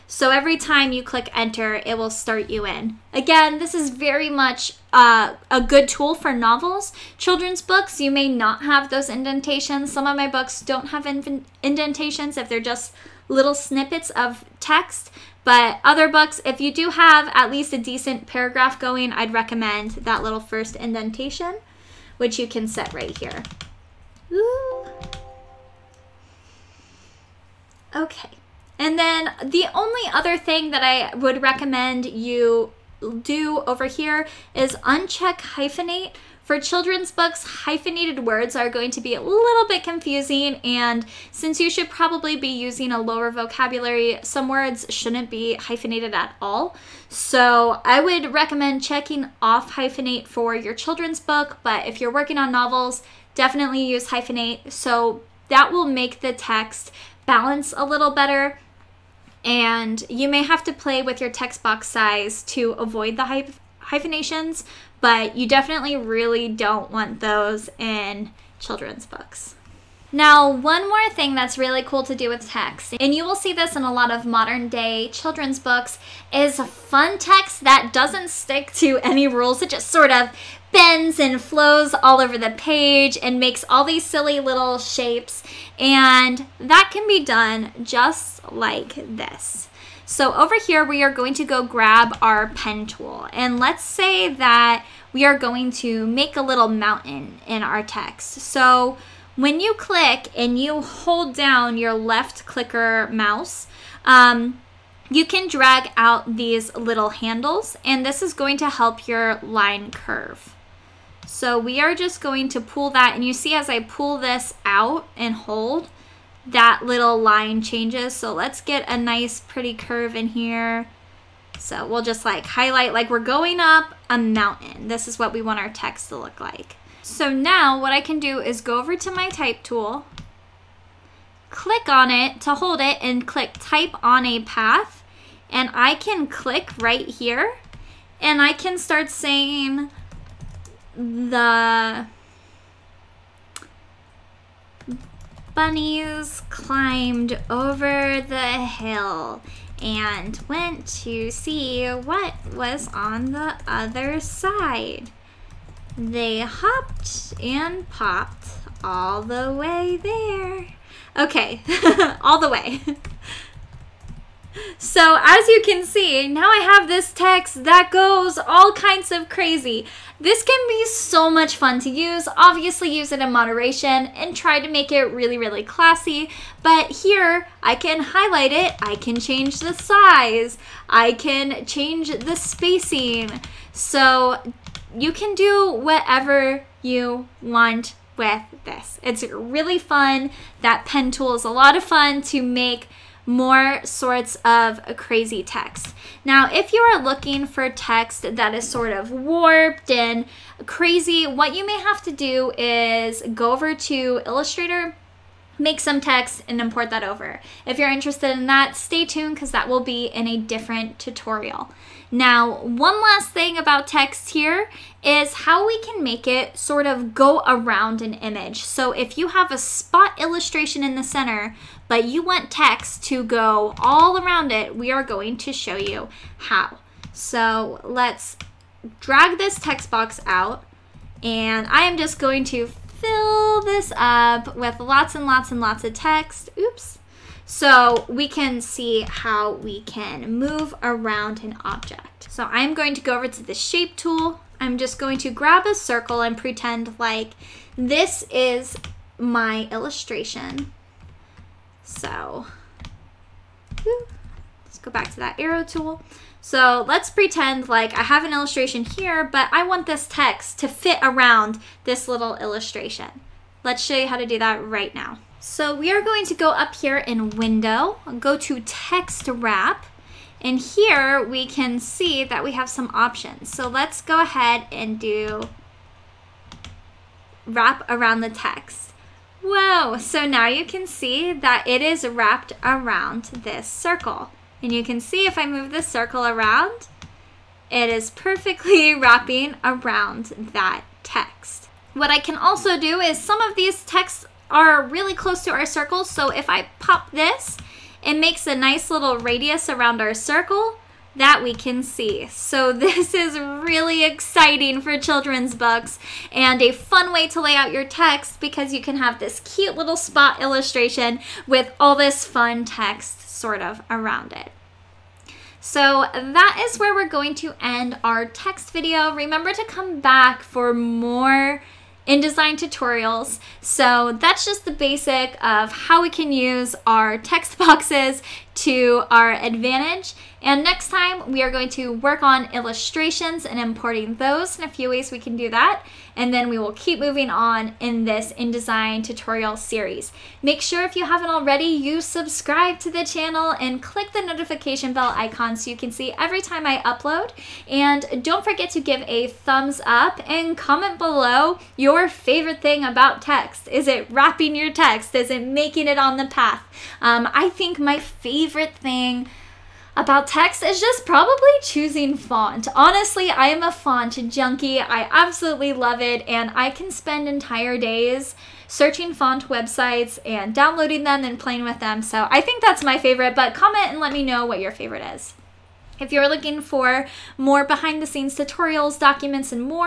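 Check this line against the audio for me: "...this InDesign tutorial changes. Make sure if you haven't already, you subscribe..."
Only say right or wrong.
wrong.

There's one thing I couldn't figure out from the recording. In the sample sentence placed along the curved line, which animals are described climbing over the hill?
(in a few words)
The bunnies.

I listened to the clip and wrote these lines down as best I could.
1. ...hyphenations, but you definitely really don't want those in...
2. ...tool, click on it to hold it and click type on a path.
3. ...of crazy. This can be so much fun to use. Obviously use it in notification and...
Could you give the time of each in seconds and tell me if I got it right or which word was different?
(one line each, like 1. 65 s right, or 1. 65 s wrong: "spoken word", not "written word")
1. 63 s right
2. 129 s right
3. 169 s wrong: "moderation", not "notification".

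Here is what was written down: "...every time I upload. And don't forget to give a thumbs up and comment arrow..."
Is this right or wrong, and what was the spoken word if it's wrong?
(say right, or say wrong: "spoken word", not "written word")
wrong: "below", not "arrow".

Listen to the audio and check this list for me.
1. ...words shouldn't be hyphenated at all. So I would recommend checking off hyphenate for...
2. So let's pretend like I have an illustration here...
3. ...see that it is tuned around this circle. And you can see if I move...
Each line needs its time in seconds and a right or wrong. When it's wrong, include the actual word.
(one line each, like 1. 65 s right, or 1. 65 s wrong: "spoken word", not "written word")
1. 44 s right
2. 256 s right
3. 280 s wrong: "wrapped", not "tuned".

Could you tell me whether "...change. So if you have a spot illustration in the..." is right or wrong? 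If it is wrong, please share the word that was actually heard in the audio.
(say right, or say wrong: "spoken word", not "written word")
wrong: "image", not "change".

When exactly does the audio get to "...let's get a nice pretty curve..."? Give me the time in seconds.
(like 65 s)
118 s.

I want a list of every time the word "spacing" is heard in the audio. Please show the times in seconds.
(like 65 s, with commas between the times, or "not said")
182 s.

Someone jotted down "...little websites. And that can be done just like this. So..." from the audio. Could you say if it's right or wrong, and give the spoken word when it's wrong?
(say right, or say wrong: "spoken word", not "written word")
wrong: "shapes", not "websites".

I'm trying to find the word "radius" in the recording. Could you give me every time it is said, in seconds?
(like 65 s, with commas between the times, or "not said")
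299 s.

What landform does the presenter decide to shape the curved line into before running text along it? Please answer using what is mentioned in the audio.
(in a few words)
A mountain.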